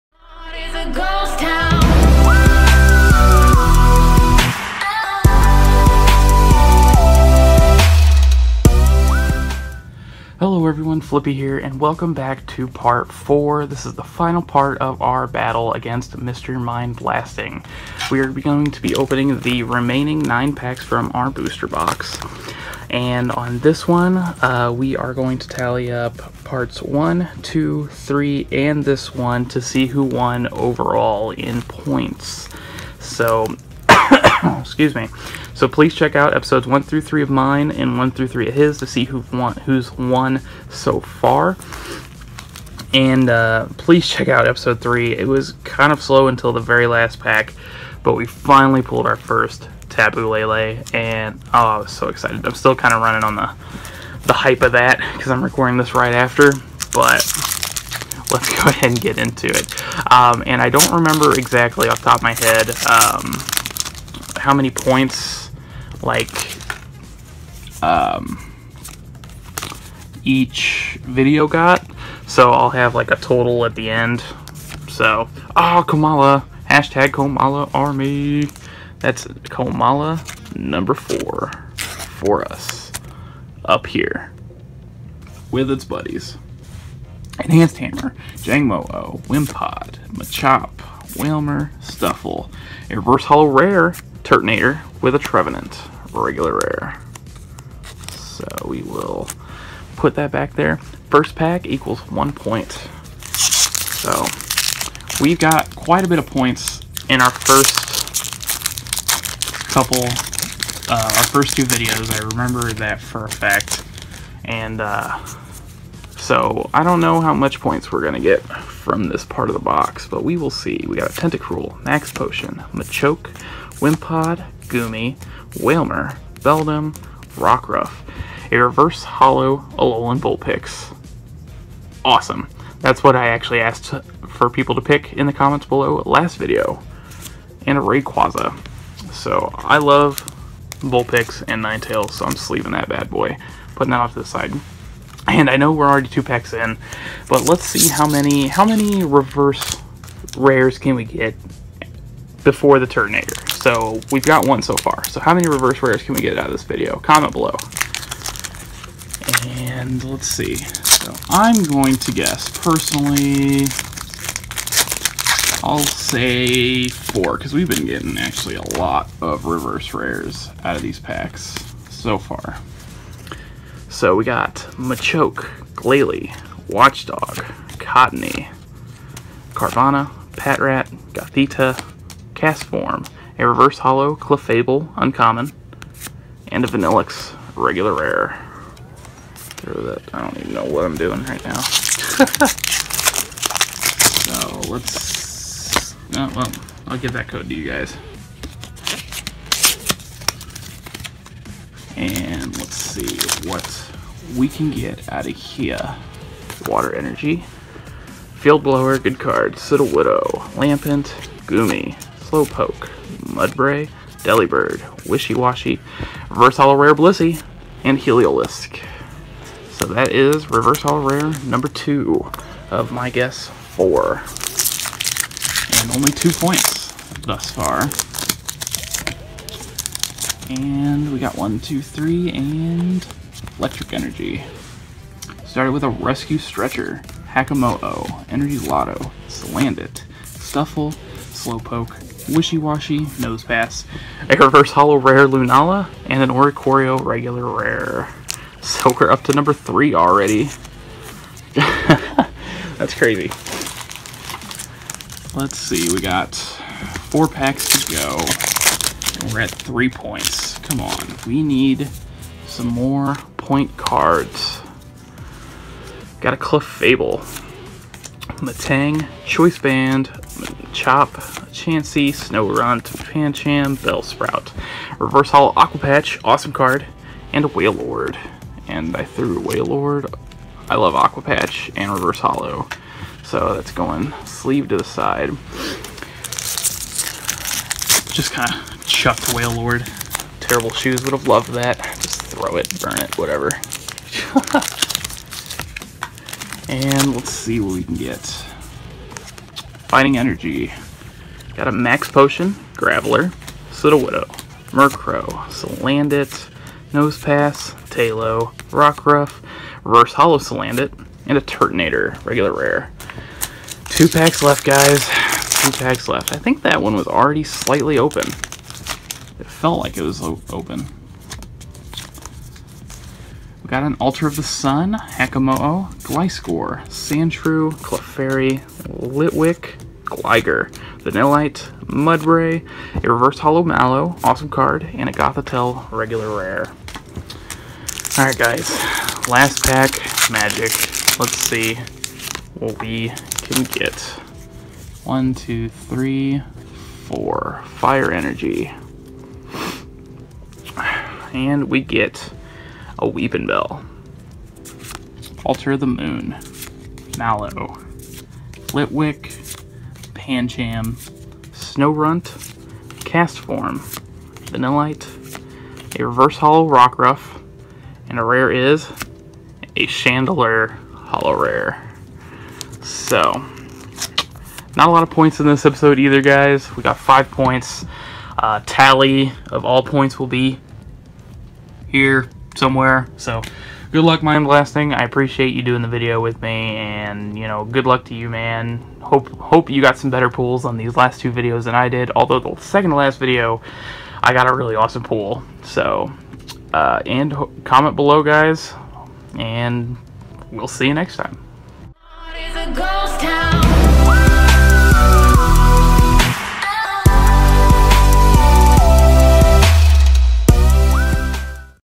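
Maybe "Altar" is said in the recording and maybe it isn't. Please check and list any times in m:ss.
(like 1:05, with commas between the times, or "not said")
5:24, 5:55.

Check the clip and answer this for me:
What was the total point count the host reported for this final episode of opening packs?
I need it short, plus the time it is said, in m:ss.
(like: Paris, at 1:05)
5, at 6:16.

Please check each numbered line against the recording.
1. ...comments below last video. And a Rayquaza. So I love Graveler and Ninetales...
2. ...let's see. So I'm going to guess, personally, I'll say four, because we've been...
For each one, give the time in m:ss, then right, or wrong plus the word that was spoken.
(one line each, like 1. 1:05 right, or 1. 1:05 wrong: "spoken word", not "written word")
1. 2:15 wrong: "Vulpix", not "Graveler"
2. 2:40 right.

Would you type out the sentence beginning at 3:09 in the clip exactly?
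Throw that, I don't even know what I'm doing right now.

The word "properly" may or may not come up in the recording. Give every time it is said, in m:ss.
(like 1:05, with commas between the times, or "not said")
not said.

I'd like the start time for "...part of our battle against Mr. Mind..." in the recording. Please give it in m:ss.
0:14.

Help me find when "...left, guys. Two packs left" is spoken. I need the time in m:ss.
5:14.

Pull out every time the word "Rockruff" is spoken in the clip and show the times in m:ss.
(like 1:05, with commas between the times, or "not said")
2:07, 5:08, 6:06.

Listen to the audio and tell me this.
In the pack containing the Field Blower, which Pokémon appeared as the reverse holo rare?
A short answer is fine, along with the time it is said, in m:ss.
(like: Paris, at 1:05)
Blissey, at 3:36.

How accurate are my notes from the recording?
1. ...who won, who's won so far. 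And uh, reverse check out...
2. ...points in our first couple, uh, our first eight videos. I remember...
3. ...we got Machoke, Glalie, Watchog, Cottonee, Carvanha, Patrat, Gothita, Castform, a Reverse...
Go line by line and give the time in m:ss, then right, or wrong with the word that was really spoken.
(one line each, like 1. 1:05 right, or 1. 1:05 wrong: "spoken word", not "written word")
1. 0:39 wrong: "please", not "reverse"
2. 1:46 wrong: "two", not "eight"
3. 2:54 right.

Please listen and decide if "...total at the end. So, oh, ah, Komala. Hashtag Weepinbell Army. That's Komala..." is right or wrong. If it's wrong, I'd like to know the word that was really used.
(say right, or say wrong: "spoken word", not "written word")
wrong: "Komala", not "Weepinbell".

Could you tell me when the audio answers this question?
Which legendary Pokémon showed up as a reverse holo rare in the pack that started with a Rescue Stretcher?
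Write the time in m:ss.
4:05.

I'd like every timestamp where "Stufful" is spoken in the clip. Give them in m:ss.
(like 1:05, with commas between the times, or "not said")
1:31, 4:00.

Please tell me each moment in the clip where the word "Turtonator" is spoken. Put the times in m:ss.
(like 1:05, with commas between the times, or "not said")
1:34, 2:32, 5:11.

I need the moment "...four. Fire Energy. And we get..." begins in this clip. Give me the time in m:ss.
5:47.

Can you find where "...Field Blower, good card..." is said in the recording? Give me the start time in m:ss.
3:28.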